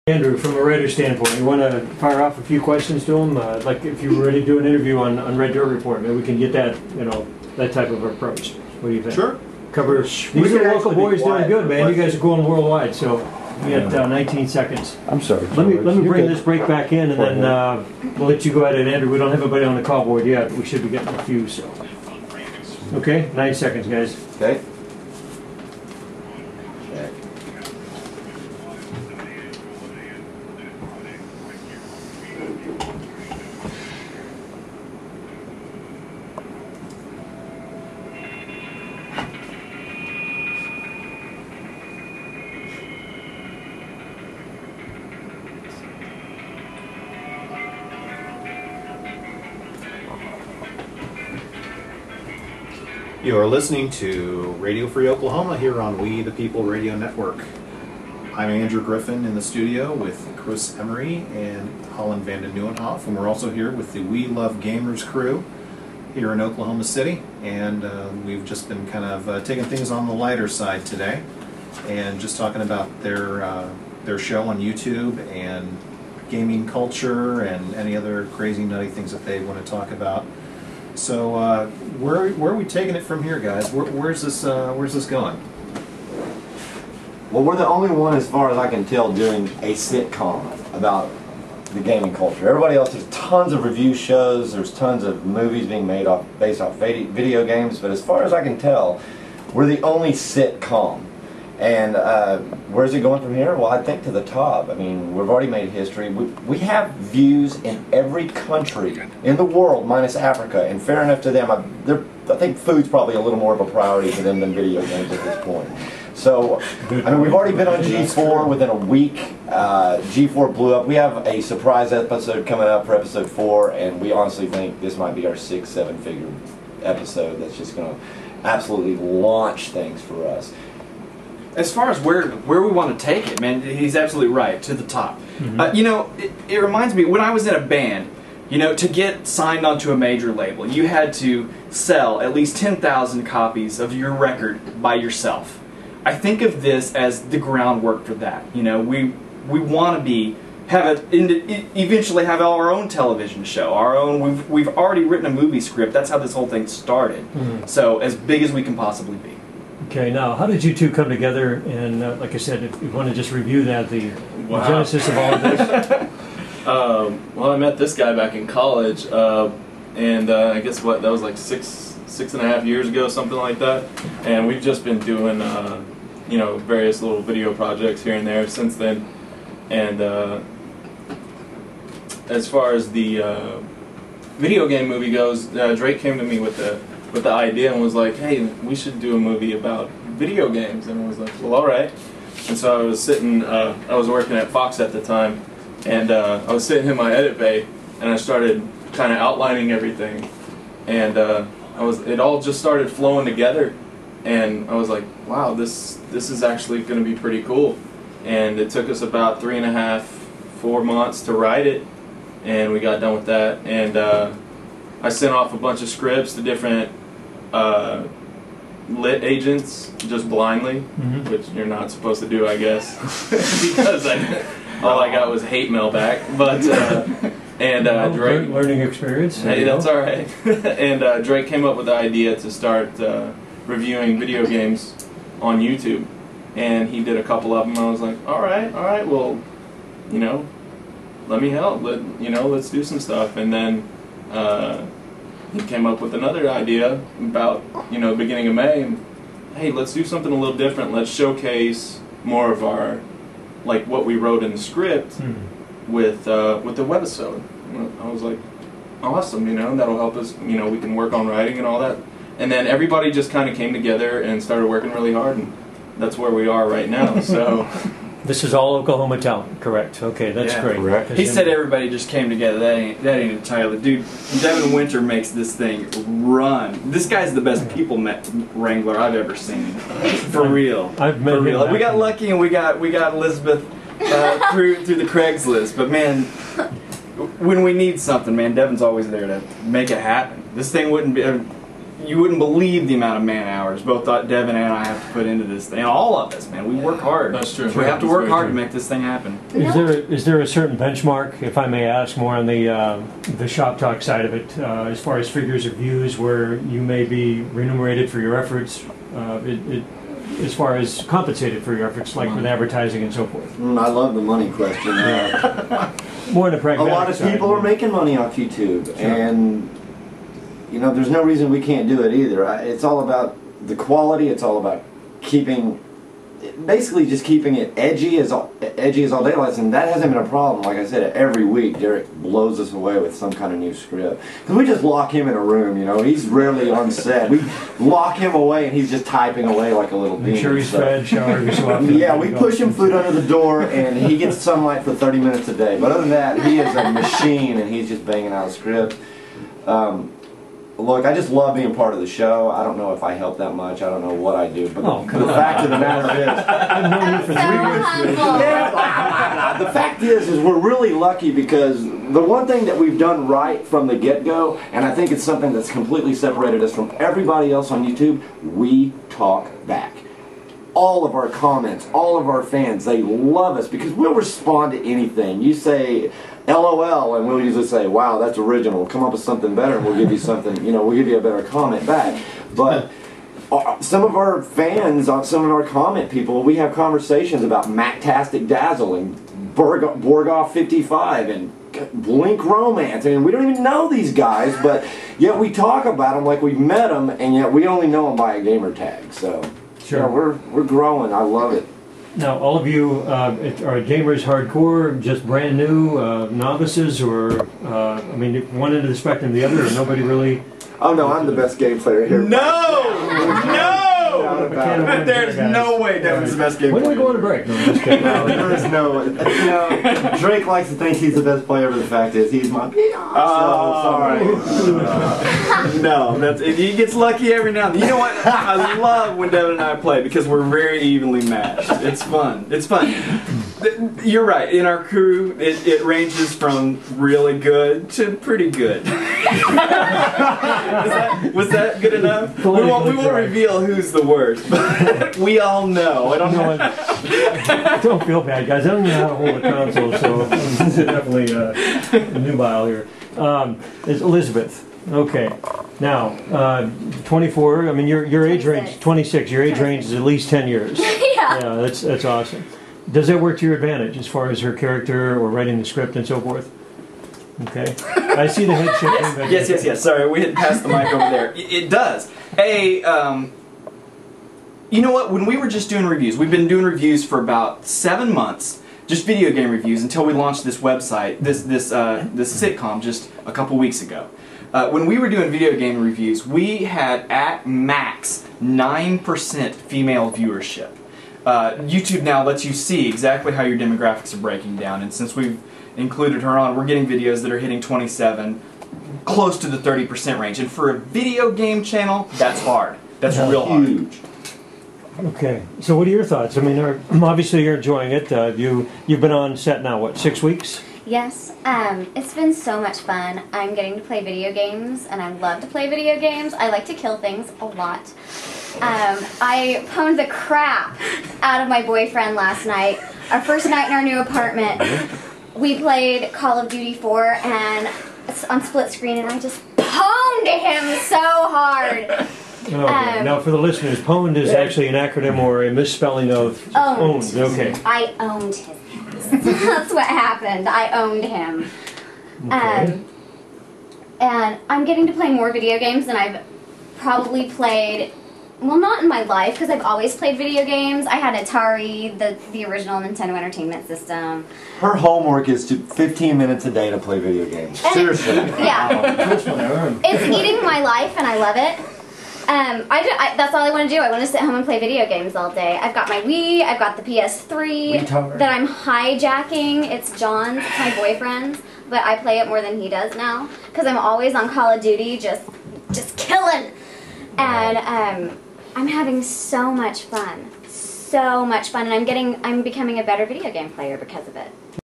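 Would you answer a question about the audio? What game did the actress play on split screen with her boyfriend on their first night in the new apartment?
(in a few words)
Call of Duty 4.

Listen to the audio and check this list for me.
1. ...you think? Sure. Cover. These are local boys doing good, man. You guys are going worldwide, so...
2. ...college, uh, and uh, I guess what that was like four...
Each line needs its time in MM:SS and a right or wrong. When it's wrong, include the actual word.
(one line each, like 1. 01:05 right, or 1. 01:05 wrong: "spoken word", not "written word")
1. 00:08 right
2. 02:48 wrong: "six", not "four".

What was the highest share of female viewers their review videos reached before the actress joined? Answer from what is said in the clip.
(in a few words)
9%.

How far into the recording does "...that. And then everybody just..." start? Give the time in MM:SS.
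04:21.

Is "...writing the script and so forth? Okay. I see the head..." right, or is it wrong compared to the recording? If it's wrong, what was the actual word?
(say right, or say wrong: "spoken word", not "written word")
right.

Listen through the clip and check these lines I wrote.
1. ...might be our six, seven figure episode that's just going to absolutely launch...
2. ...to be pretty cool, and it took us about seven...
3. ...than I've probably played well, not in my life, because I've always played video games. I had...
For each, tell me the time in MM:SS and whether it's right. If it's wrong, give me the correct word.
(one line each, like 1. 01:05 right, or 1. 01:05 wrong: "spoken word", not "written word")
1. 02:04 right
2. 03:27 wrong: "three", not "seven"
3. 09:05 right.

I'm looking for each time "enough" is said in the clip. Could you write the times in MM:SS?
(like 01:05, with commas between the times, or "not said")
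01:51, 07:21.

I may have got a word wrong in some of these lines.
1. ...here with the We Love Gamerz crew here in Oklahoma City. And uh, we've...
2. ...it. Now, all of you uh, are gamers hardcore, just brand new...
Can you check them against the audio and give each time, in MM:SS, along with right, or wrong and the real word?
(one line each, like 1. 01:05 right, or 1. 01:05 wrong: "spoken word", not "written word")
1. 01:03 right
2. 06:41 right.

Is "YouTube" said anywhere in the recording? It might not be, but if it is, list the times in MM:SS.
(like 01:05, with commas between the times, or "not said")
01:14, 03:55, 05:18, 06:07, 08:11.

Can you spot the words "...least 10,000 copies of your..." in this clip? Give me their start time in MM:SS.
02:22.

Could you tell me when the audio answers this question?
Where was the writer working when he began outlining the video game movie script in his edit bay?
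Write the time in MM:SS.
03:14.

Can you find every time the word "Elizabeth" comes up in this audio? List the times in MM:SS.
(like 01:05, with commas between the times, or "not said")
04:43, 07:33.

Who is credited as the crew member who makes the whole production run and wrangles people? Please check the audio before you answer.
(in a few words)
Devin Winter.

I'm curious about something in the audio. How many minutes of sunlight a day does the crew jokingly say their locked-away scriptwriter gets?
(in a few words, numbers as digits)
30.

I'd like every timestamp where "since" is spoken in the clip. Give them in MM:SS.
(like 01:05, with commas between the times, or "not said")
02:58, 08:14.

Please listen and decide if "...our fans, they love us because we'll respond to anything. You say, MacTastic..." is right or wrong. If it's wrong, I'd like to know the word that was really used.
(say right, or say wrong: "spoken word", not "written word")
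wrong: "LOL", not "MacTastic".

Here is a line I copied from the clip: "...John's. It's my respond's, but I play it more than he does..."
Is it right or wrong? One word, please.
wrong.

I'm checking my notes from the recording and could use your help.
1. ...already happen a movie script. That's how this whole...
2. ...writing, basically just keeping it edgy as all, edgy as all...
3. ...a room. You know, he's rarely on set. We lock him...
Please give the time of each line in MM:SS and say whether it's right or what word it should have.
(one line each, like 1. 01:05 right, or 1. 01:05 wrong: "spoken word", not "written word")
1. 02:34 wrong: "written", not "happen"
2. 05:25 wrong: "keeping", not "writing"
3. 05:35 right.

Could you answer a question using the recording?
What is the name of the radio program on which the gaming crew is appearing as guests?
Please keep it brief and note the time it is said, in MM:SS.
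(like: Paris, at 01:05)
Radio Free Oklahoma, at 00:54.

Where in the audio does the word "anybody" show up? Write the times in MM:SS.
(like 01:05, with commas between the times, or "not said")
00:19.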